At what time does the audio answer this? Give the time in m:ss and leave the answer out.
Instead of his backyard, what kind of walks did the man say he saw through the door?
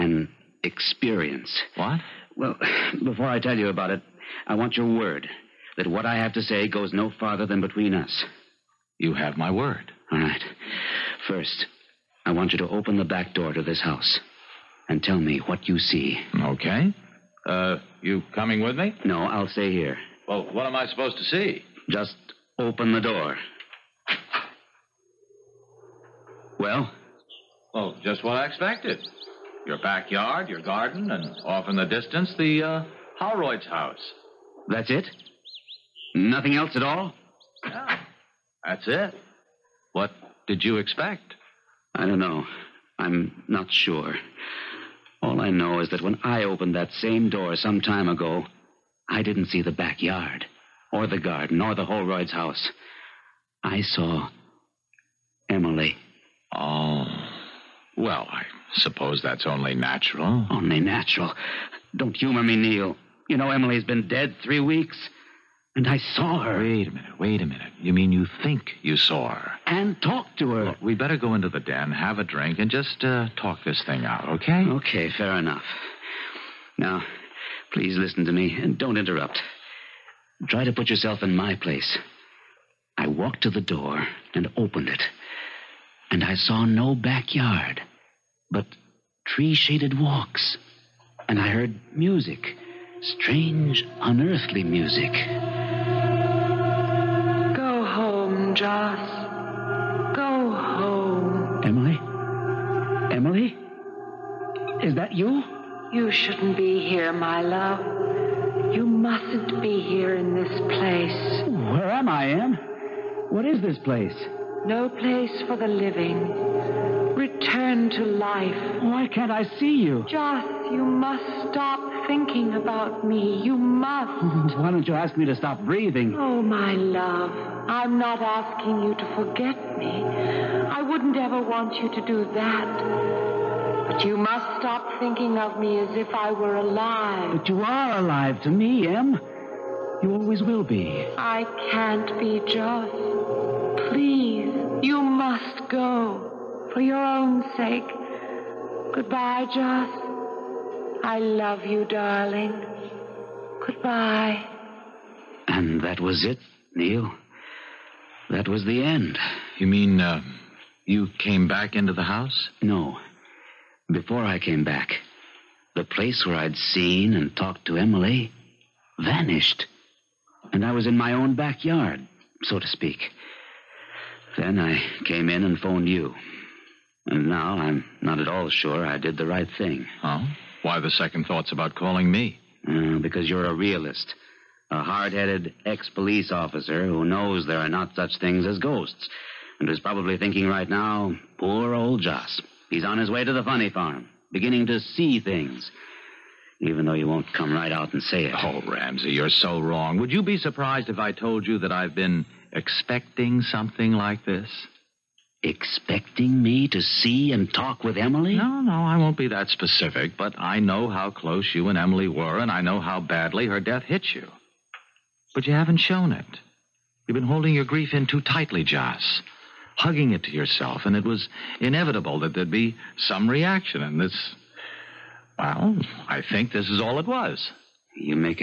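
1:29.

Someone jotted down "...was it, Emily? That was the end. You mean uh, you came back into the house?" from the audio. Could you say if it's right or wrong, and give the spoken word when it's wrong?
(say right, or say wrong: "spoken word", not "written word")
wrong: "Neil", not "Emily".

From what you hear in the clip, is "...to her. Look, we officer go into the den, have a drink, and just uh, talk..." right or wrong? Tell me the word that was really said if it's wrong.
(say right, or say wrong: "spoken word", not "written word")
wrong: "better", not "officer".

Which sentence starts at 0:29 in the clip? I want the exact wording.
Your backyard, your garden, and off in the distance, the uh, house.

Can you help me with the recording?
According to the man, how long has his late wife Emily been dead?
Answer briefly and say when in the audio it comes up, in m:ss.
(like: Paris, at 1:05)
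3 weeks, at 1:04.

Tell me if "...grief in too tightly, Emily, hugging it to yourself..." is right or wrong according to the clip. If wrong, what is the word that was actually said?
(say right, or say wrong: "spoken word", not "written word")
wrong: "Joss", not "Emily".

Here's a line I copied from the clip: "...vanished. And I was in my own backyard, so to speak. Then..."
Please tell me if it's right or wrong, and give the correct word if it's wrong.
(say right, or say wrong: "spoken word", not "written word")
right.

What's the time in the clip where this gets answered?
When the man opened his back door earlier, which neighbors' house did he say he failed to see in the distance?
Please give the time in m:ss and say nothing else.
0:51.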